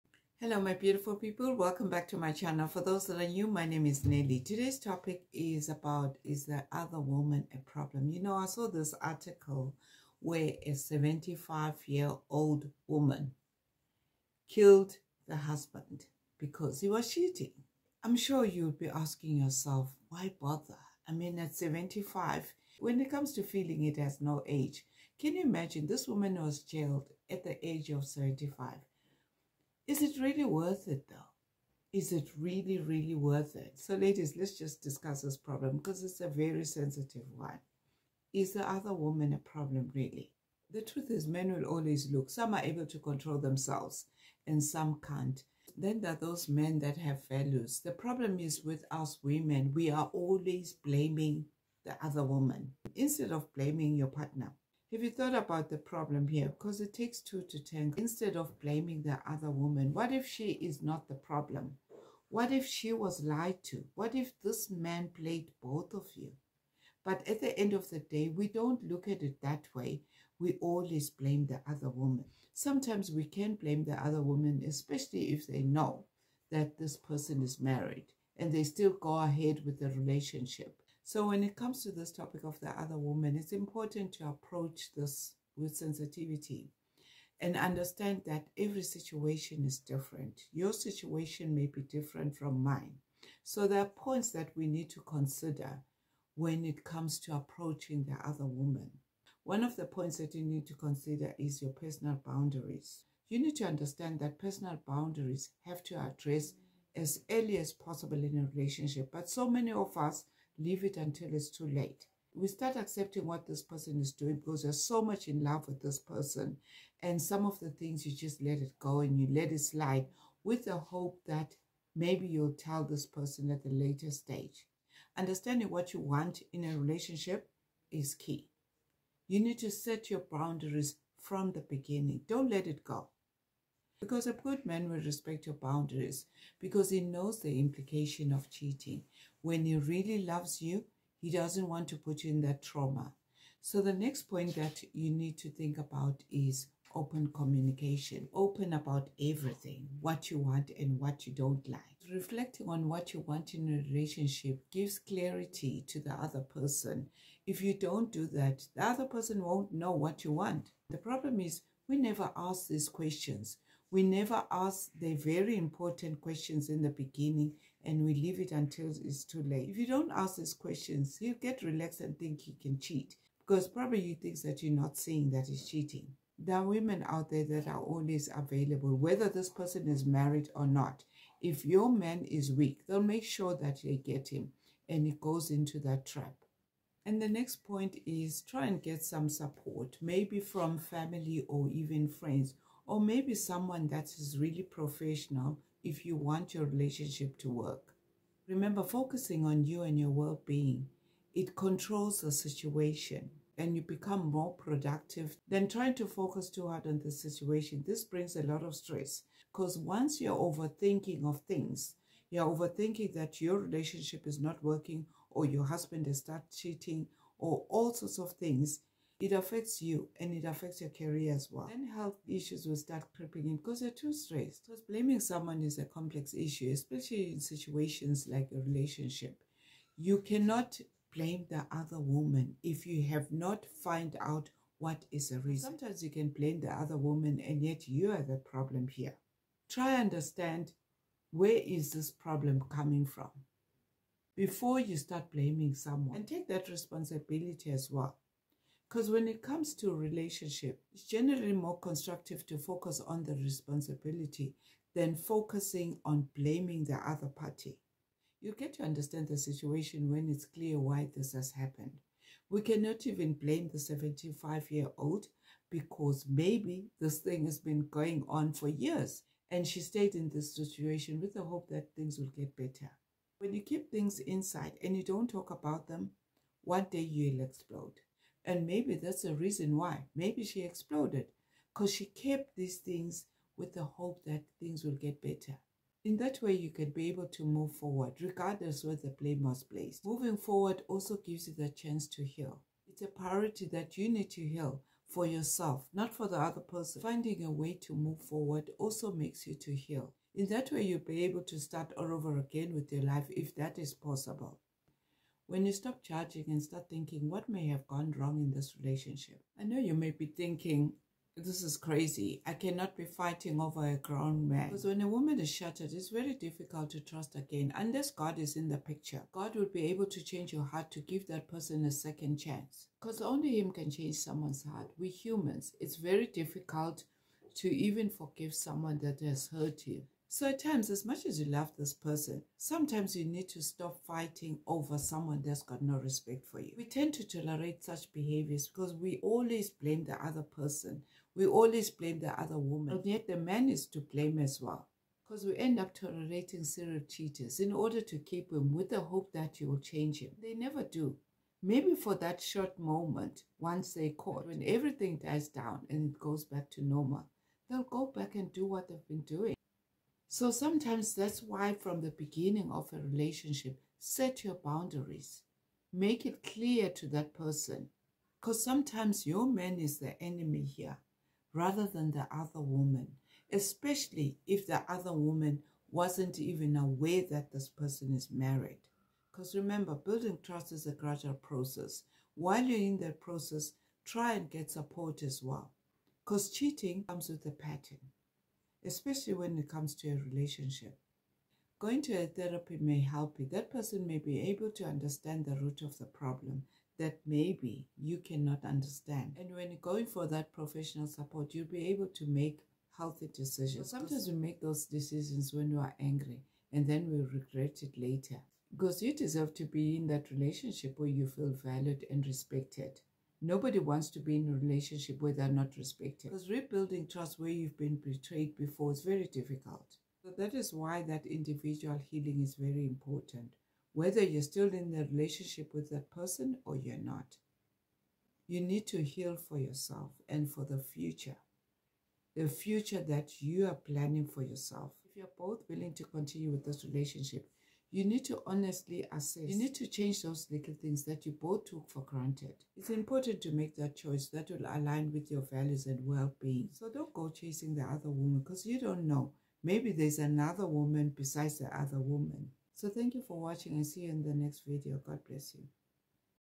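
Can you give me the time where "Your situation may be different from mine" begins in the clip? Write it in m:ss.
1:30.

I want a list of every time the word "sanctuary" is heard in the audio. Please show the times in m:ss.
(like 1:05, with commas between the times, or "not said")
not said.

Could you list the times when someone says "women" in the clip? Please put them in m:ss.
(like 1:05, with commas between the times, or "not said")
0:49, 2:56.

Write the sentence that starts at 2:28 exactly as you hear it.
Open about everything, what you want and what you don't like.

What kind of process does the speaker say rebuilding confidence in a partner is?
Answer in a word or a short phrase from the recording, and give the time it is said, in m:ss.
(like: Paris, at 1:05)
A gradual process, at 6:20.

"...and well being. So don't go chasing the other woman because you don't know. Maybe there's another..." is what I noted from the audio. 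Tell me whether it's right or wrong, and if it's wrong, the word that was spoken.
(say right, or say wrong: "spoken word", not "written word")
right.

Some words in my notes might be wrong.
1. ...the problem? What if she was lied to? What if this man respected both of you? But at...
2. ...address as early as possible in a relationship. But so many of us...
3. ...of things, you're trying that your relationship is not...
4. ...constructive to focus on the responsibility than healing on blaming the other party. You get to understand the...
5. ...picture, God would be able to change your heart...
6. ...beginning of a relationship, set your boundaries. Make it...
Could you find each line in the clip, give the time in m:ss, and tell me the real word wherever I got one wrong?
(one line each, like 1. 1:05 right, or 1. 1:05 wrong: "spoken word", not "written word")
1. 1:01 wrong: "played", not "respected"
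2. 1:45 right
3. 3:31 wrong: "overthinking", not "trying"
4. 4:11 wrong: "focusing", not "healing"
5. 5:18 right
6. 6:02 right.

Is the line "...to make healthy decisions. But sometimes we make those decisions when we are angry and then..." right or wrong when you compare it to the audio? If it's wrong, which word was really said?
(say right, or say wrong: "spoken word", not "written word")
right.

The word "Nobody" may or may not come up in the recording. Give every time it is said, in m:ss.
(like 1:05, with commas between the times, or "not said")
6:53.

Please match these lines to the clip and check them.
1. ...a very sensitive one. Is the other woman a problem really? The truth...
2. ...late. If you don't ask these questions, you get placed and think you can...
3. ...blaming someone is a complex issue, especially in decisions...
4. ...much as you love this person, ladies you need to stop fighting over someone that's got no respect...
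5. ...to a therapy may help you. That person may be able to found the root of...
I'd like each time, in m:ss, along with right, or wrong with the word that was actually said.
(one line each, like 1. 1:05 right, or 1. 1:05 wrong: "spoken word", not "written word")
1. 0:36 right
2. 2:49 wrong: "relaxed", not "placed"
3. 3:44 wrong: "situations", not "decisions"
4. 5:31 wrong: "sometimes", not "ladies"
5. 6:32 wrong: "understand", not "found".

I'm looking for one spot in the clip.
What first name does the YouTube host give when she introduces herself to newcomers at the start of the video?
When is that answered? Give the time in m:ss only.
0:04.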